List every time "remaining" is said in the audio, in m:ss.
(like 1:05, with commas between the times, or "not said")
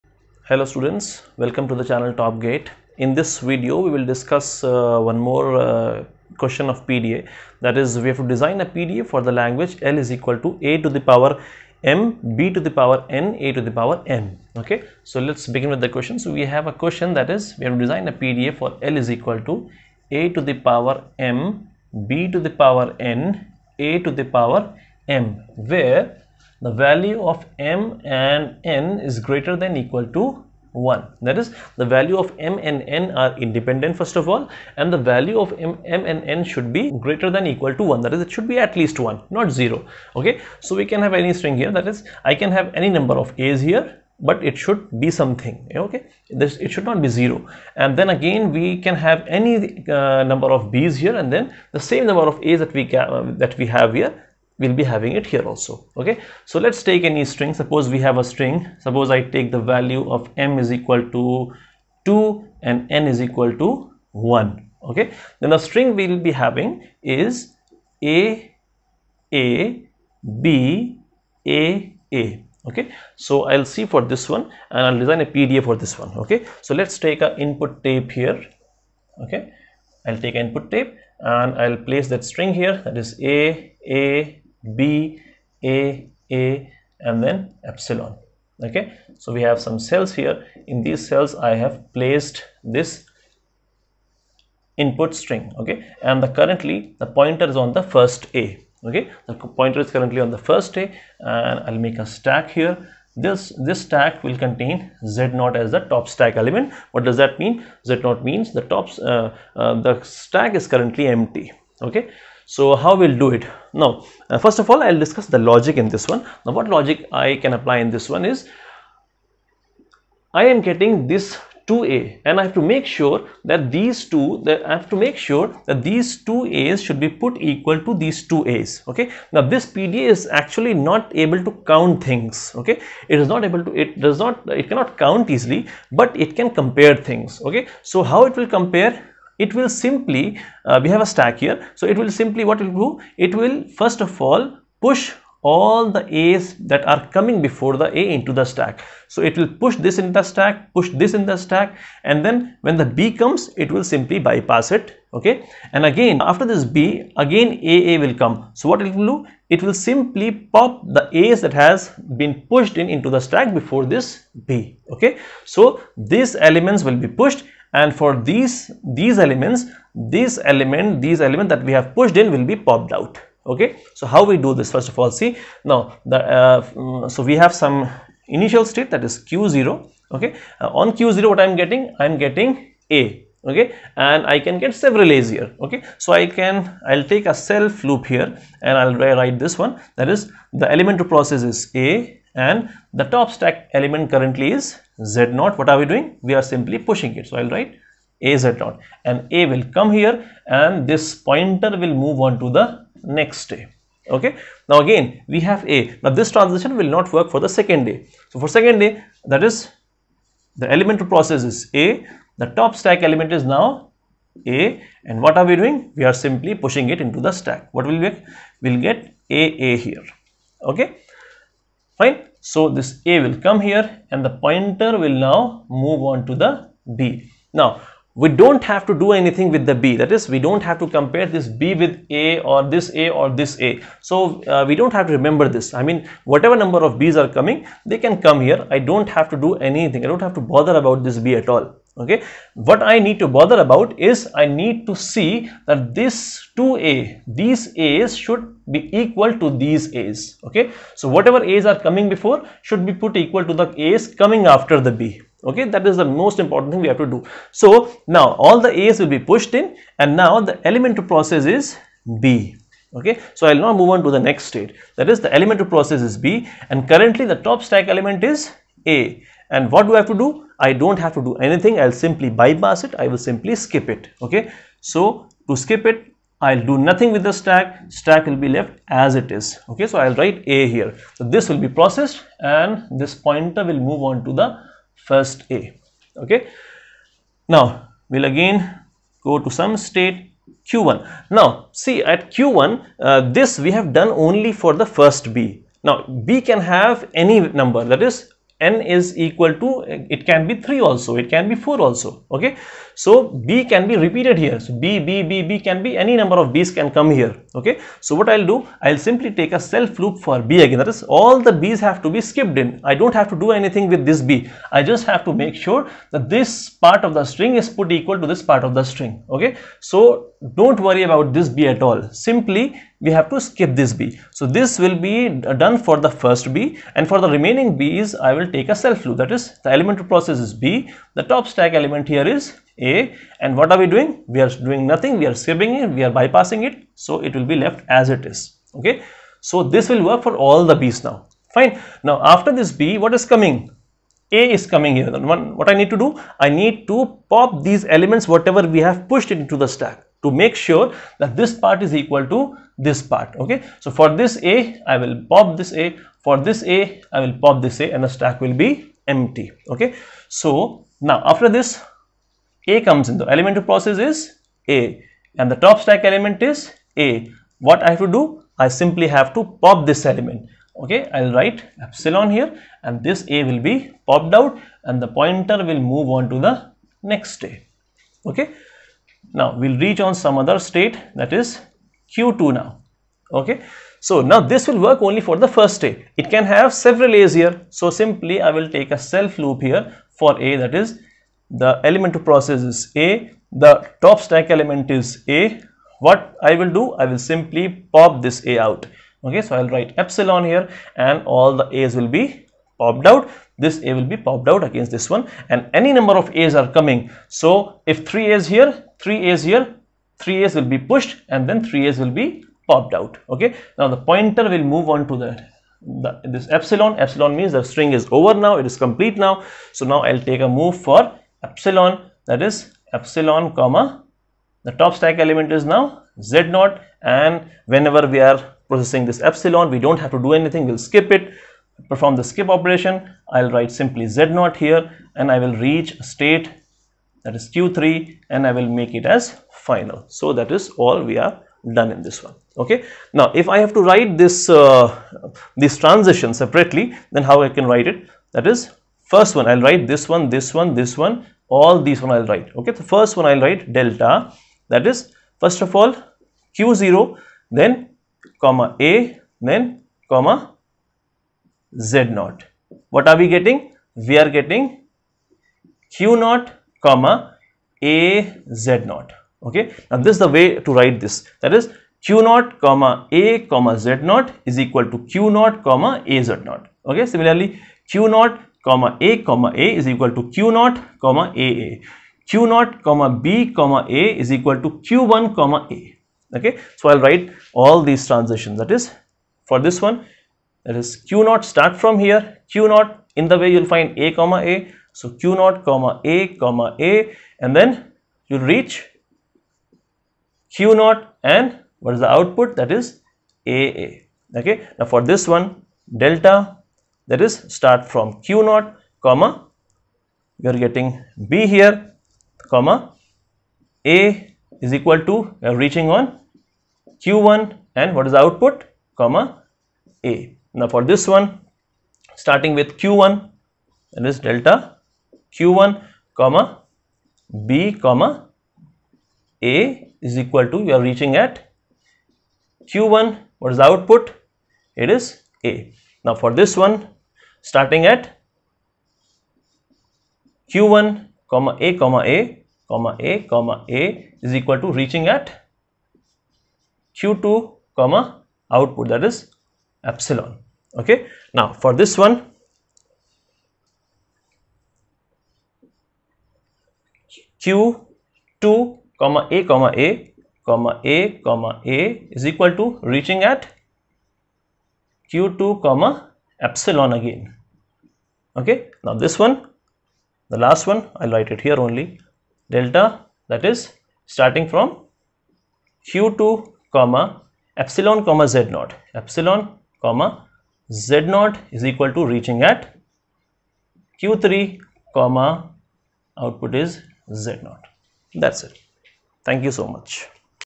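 5:27.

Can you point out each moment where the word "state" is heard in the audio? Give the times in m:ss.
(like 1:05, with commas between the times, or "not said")
2:58, 4:24, 4:49, 6:20, 7:16.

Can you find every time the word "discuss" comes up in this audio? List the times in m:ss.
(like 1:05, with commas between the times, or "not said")
0:04, 1:55.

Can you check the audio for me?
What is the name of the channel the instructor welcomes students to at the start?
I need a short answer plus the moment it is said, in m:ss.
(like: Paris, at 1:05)
Top Gate, at 0:02.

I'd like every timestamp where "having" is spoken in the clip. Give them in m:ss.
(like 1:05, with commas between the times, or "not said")
0:54, 1:06.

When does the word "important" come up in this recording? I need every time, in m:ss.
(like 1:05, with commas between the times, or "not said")
4:16.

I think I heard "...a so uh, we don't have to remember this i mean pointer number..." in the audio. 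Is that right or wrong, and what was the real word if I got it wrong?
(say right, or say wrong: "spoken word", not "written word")
wrong: "whatever", not "pointer".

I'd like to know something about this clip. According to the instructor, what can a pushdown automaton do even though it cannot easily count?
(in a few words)
compare things.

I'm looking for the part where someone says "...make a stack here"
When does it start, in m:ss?
1:41.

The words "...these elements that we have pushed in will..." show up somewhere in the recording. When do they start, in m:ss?
2:51.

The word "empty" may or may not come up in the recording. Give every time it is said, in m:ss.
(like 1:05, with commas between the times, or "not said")
1:51, 5:59.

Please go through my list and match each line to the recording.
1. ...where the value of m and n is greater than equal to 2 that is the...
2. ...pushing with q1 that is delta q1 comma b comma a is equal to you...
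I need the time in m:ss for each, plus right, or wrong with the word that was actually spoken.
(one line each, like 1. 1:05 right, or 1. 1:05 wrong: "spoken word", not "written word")
1. 0:25 wrong: "1", not "2"
2. 8:42 wrong: "starting", not "pushing".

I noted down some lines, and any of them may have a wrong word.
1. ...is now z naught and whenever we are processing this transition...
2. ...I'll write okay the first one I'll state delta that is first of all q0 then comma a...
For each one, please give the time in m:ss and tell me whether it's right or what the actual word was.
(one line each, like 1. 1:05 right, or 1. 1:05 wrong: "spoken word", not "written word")
1. 7:05 wrong: "epsilon", not "transition"
2. 7:32 wrong: "write", not "state".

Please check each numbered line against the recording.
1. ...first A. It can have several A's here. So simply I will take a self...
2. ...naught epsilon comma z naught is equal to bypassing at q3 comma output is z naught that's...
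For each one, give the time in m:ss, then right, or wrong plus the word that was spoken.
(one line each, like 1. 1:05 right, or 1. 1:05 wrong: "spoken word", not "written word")
1. 6:25 right
2. 9:38 wrong: "reaching", not "bypassing".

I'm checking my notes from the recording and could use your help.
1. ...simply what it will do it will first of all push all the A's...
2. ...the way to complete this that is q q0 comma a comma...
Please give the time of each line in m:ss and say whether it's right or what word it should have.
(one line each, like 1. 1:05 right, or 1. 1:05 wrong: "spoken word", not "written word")
1. 2:22 right
2. 7:50 wrong: "write", not "complete".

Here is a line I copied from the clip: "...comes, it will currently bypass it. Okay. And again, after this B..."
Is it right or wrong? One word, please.
wrong.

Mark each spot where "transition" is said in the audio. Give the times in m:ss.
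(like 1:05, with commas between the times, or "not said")
3:26, 7:25, 8:08.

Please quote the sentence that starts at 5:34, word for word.
We are doing nothing, we are skipping it, we are bypassing it, so it will be left as it is.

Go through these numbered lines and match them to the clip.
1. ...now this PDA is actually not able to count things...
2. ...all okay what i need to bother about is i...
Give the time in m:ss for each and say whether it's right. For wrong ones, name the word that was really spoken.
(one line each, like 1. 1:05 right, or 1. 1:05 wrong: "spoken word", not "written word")
1. 2:09 right
2. 4:01 right.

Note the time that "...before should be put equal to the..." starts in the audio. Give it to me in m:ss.
4:12.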